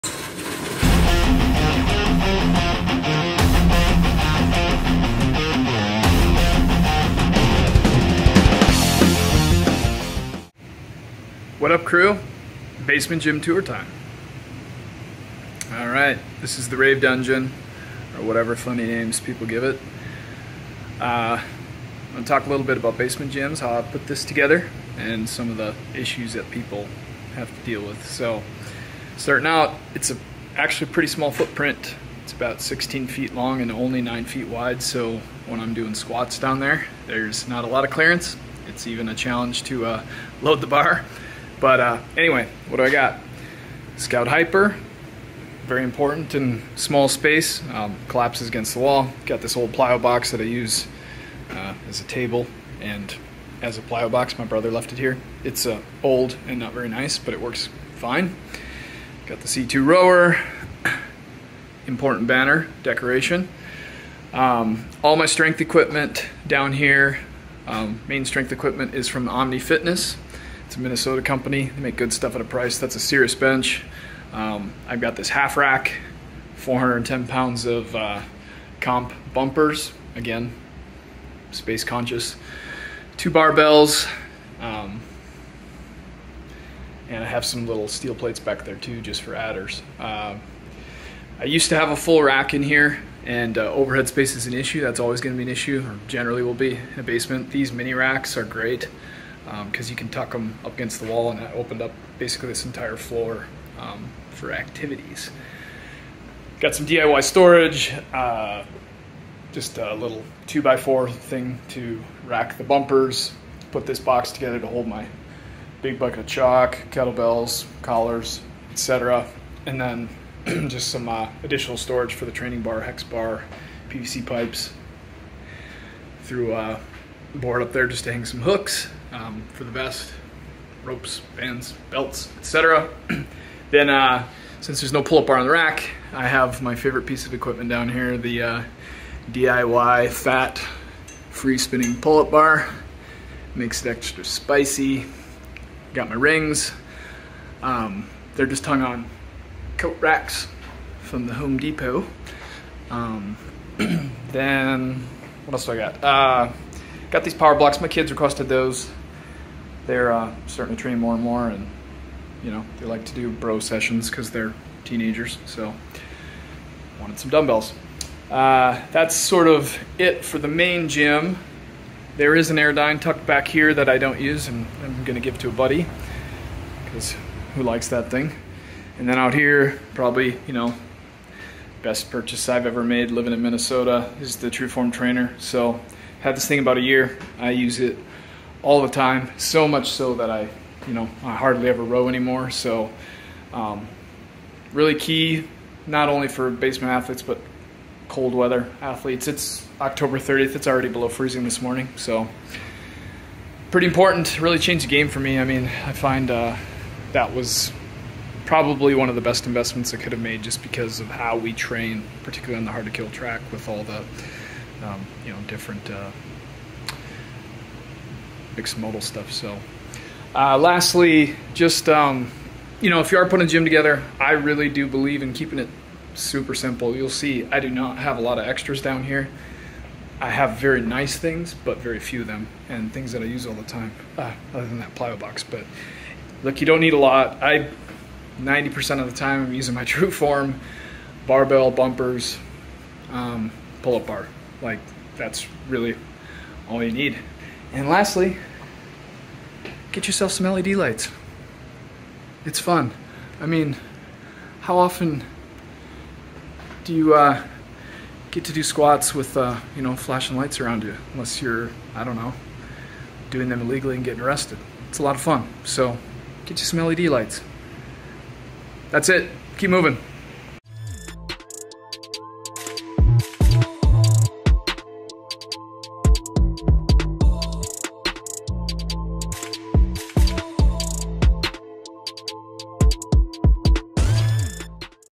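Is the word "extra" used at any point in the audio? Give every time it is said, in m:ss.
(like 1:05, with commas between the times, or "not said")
2:23, 3:48.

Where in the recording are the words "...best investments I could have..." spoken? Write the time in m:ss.
3:29.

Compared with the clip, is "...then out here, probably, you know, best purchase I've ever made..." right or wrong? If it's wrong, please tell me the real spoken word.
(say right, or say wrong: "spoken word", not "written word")
right.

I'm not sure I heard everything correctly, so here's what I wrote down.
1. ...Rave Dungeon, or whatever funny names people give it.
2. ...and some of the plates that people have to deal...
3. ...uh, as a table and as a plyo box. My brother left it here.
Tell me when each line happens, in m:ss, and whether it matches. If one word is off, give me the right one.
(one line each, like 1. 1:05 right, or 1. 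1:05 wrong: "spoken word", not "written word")
1. 0:16 right
2. 0:24 wrong: "issues", not "plates"
3. 0:51 right.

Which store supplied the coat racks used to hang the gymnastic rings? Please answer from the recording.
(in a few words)
Home Depot.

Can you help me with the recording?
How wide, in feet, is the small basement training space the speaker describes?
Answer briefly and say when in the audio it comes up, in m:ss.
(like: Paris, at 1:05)
9 feet, at 0:34.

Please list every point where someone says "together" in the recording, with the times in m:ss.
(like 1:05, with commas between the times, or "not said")
0:24, 1:54, 3:43.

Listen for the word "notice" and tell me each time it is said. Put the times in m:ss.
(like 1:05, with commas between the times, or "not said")
not said.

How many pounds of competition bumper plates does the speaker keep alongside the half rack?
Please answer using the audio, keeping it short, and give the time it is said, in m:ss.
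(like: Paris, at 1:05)
410 pounds, at 1:16.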